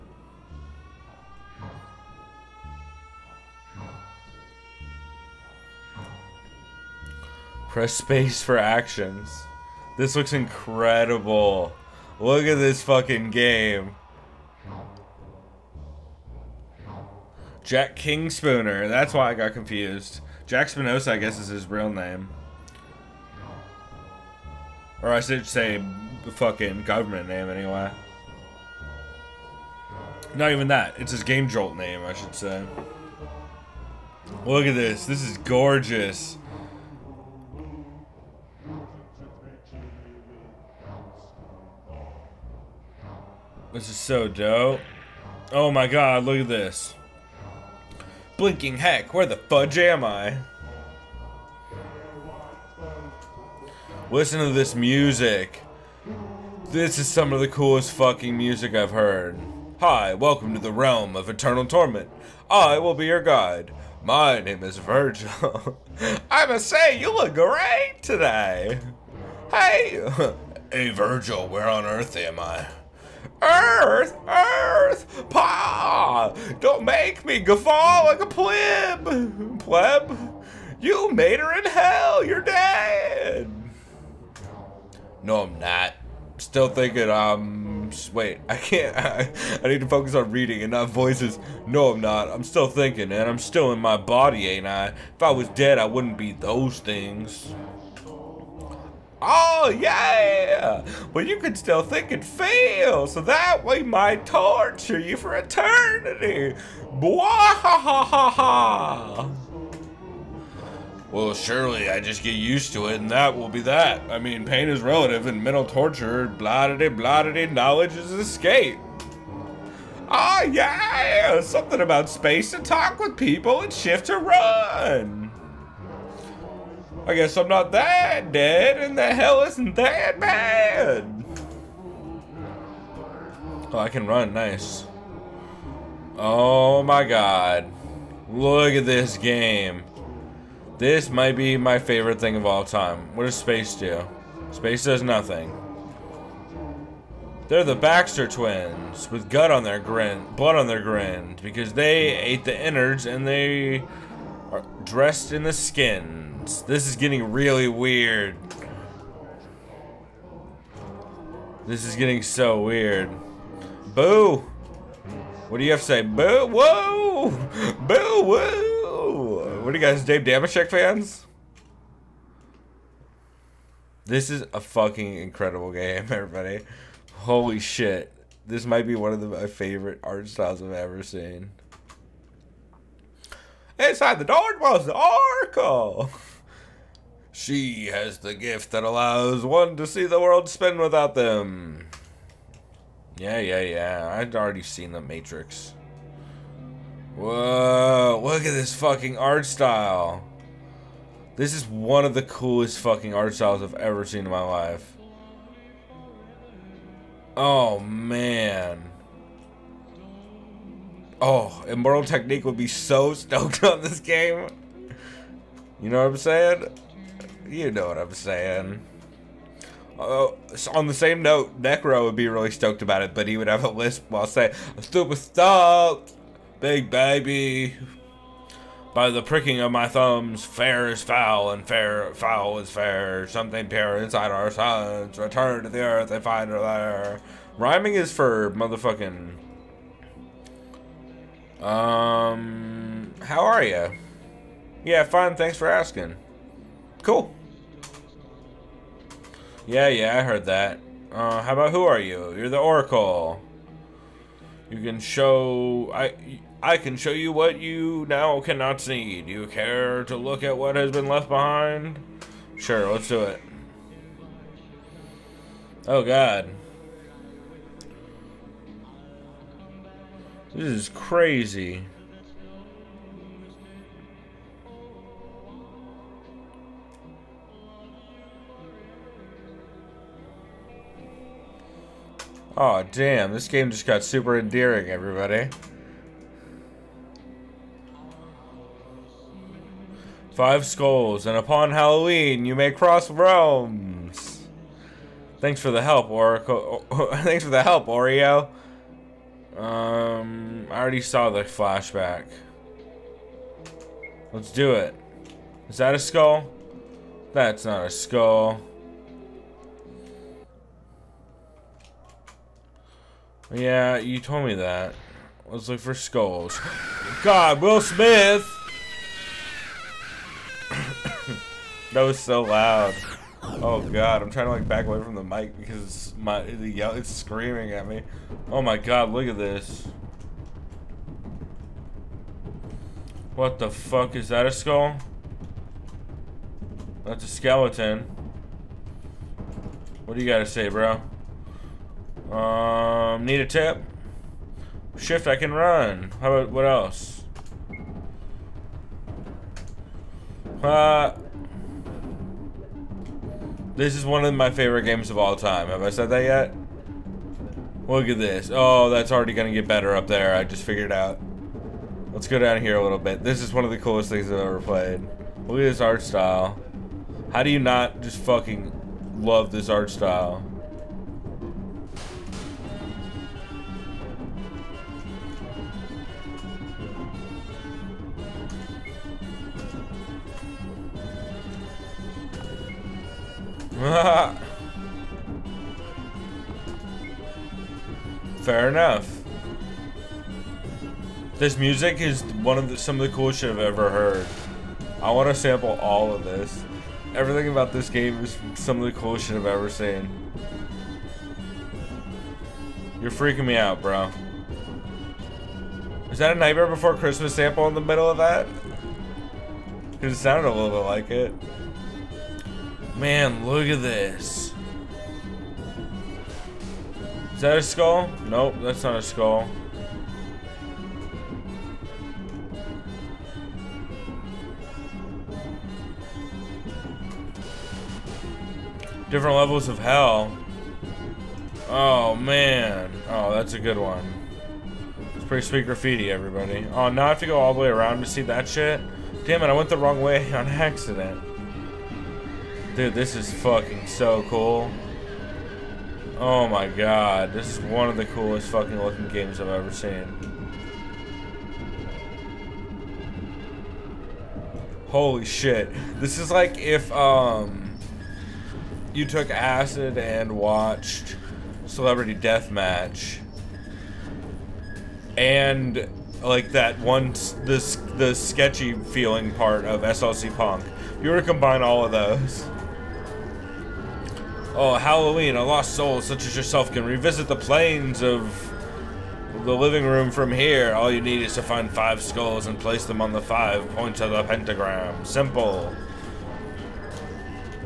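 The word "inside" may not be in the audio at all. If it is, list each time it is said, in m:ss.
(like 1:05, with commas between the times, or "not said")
3:03, 3:53.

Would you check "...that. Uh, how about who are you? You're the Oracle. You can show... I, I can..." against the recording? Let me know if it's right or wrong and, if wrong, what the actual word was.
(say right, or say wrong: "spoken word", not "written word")
right.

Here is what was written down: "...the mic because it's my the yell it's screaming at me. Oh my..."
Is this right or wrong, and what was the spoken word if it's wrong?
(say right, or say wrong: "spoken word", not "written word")
right.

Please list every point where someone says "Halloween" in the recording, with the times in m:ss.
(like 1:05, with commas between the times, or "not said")
4:51, 7:54.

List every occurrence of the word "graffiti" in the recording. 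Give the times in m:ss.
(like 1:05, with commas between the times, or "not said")
7:15.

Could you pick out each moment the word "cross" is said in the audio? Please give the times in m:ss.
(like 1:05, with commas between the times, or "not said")
4:52.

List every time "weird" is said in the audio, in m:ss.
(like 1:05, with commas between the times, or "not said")
2:37, 2:42.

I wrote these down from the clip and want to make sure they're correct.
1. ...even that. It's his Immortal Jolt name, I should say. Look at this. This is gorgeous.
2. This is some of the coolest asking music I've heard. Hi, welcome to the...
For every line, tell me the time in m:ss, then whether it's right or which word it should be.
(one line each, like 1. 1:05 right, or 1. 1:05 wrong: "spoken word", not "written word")
1. 0:30 wrong: "Game", not "Immortal"
2. 0:56 wrong: "fucking", not "asking".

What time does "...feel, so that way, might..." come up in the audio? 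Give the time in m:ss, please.
1:42.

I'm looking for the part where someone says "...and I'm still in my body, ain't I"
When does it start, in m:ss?
1:33.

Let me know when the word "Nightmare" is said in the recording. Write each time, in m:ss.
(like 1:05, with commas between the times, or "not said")
6:46.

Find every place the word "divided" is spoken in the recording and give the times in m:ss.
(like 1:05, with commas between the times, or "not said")
not said.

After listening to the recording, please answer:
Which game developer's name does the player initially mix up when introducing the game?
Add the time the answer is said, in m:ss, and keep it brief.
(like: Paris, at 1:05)
Jack King-Spooner, at 0:17.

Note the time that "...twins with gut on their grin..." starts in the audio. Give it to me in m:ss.
2:28.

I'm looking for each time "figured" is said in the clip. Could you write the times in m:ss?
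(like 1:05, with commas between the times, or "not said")
6:00.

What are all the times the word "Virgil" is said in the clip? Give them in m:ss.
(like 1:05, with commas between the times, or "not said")
1:04, 1:10.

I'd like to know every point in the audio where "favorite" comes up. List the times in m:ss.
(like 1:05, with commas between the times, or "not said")
2:21, 2:59, 5:54.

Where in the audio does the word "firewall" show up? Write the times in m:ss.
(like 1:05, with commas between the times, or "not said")
not said.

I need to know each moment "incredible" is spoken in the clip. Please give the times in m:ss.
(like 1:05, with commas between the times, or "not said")
0:10, 2:55.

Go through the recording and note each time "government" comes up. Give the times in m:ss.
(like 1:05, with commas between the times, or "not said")
0:26.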